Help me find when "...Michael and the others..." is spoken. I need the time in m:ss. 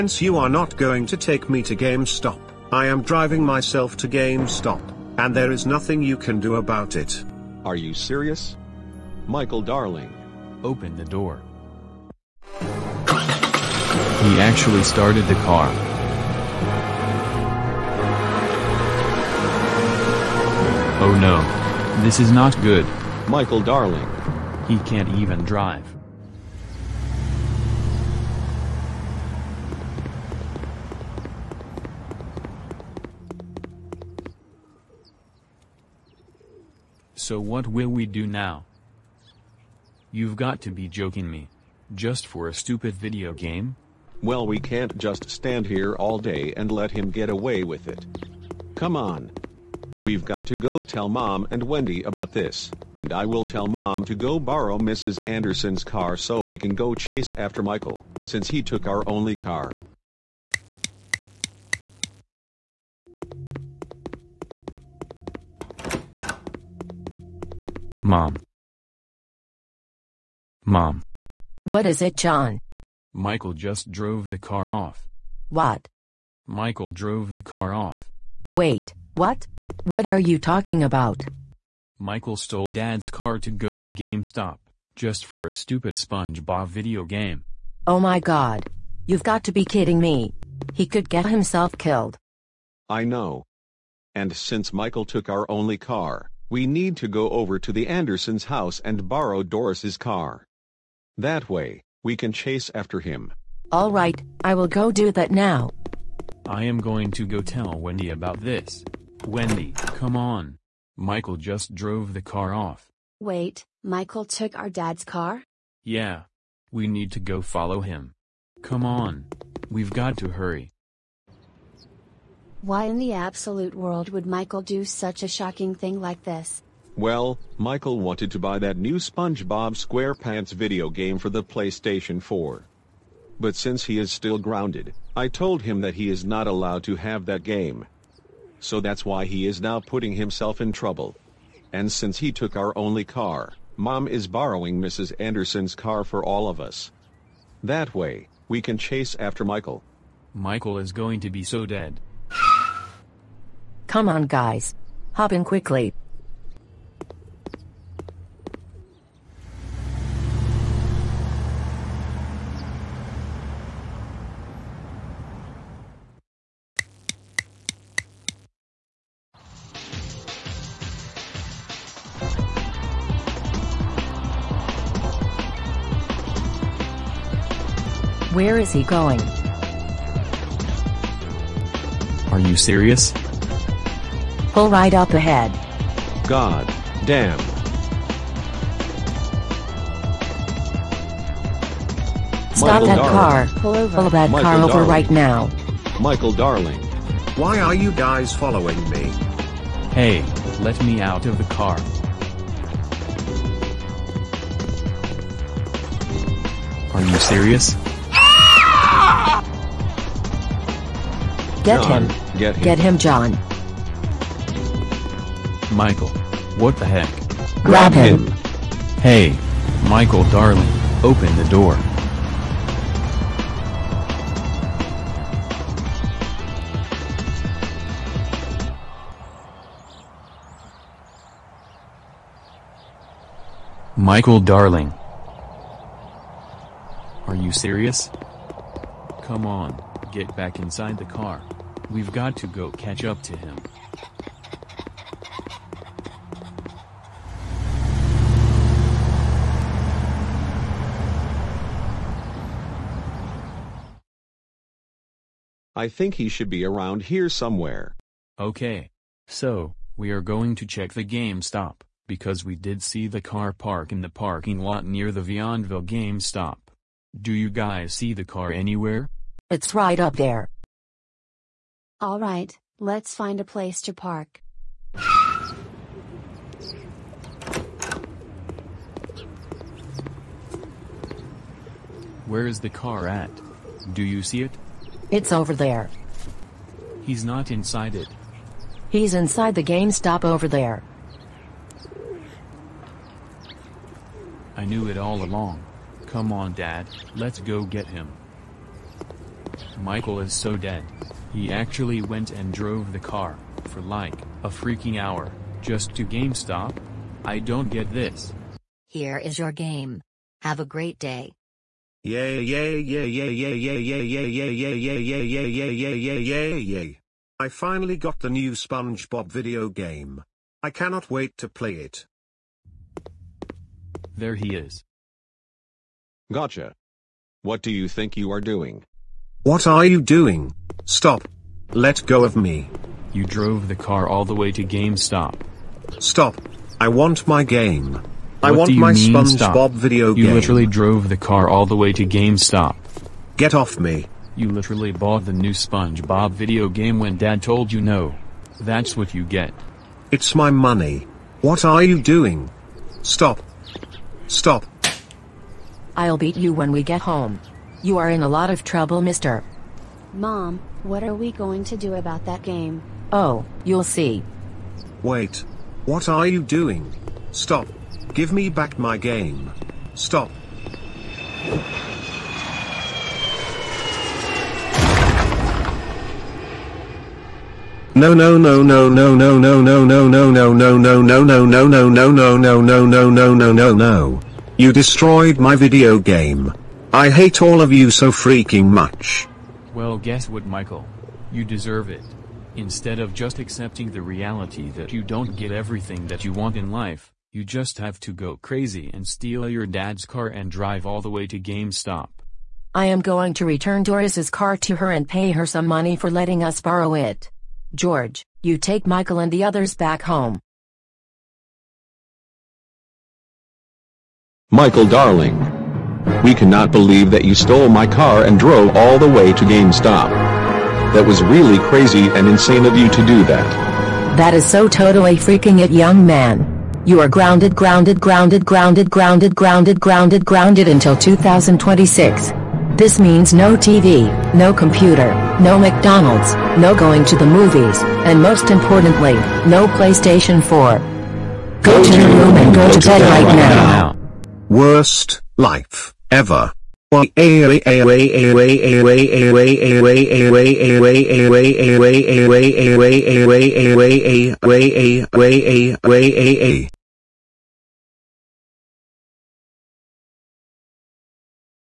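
6:48.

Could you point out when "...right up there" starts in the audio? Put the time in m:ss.
4:29.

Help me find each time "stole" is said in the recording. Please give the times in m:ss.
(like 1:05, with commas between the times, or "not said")
1:22, 6:57.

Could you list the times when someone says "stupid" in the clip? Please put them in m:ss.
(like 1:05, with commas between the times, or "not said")
0:42, 1:25.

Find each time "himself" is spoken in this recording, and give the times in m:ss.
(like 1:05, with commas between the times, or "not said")
1:31, 2:20.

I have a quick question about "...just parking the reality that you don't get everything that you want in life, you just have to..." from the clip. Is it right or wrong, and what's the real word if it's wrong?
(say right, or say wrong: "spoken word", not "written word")
wrong: "accepting", not "parking".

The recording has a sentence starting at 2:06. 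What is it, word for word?
Well, Michael wanted to buy that new SpongeBob SquarePants video game for the PlayStation 4.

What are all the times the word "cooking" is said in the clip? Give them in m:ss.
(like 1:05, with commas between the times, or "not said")
not said.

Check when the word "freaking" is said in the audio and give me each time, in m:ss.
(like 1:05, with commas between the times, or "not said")
5:04, 6:28, 7:05.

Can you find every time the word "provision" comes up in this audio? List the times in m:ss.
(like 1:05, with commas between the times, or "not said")
not said.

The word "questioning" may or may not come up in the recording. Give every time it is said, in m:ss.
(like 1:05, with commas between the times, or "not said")
not said.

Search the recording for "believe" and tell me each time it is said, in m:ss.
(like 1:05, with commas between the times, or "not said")
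6:56.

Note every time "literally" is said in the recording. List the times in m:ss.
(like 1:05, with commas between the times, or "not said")
5:40, 5:44.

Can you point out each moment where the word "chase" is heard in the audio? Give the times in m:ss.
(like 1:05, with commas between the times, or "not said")
0:56, 1:42, 2:28.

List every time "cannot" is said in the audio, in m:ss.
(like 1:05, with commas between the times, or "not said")
5:20, 6:56.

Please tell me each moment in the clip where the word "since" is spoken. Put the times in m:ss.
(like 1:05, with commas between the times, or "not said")
0:58, 1:34, 2:13, 2:21.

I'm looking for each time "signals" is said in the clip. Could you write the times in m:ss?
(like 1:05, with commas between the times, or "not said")
not said.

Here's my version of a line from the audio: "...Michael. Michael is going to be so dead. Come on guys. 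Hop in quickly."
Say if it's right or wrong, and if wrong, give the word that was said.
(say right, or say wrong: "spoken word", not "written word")
right.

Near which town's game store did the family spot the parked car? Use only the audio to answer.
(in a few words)
Vianville.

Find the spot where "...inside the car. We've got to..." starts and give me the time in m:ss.
4:00.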